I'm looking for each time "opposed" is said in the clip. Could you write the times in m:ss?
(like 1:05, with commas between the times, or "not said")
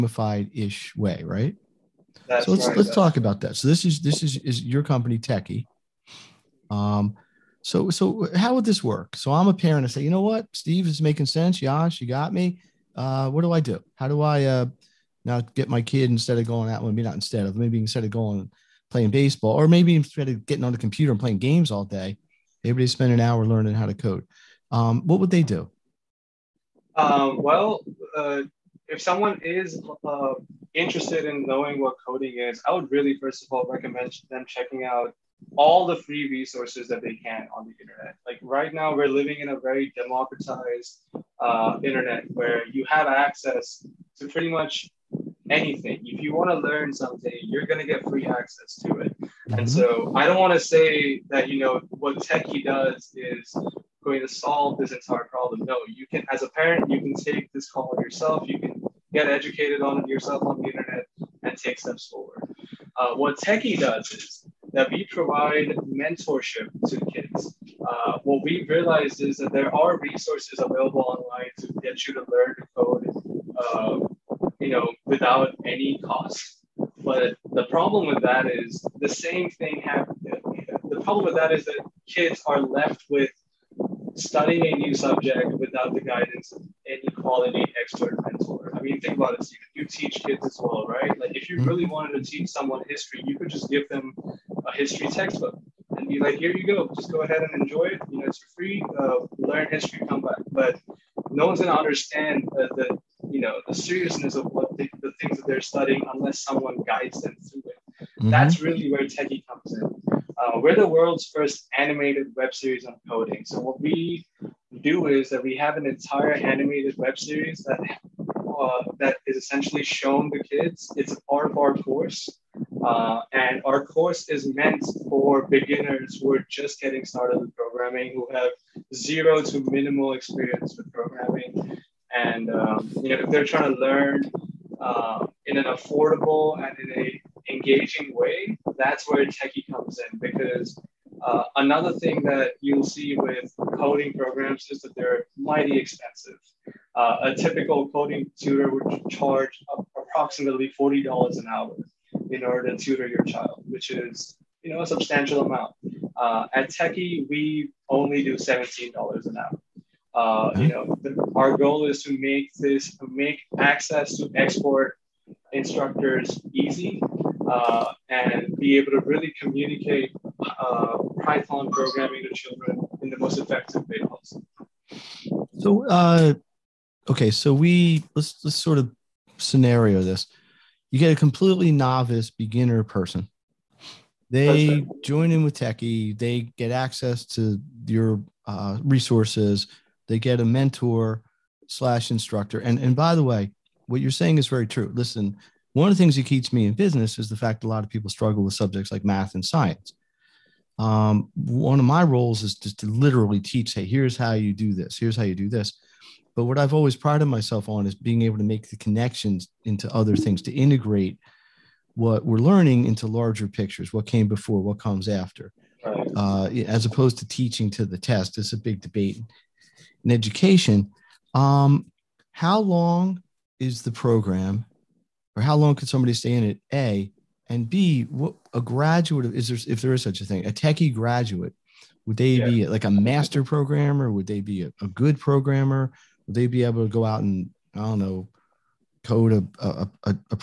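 3:36.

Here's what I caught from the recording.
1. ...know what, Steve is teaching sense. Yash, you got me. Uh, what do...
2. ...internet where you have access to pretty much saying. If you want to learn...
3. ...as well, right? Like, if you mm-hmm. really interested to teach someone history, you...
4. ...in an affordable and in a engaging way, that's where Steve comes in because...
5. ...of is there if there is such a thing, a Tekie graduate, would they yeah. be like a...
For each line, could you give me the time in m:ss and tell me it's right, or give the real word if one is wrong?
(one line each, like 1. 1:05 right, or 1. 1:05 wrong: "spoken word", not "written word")
1. 0:10 wrong: "making", not "teaching"
2. 0:41 wrong: "anything", not "saying"
3. 1:30 wrong: "wanted", not "interested"
4. 2:15 wrong: "Tekie", not "Steve"
5. 3:49 right.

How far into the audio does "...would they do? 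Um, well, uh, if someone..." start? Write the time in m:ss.
0:25.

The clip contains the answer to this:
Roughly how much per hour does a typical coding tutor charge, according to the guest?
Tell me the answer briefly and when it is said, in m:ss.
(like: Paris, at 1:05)
$40, at 2:30.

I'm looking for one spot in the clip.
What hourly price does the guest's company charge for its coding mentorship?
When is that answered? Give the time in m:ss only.
2:38.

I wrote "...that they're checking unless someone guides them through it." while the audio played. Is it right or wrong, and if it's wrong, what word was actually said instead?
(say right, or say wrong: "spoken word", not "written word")
wrong: "studying", not "checking".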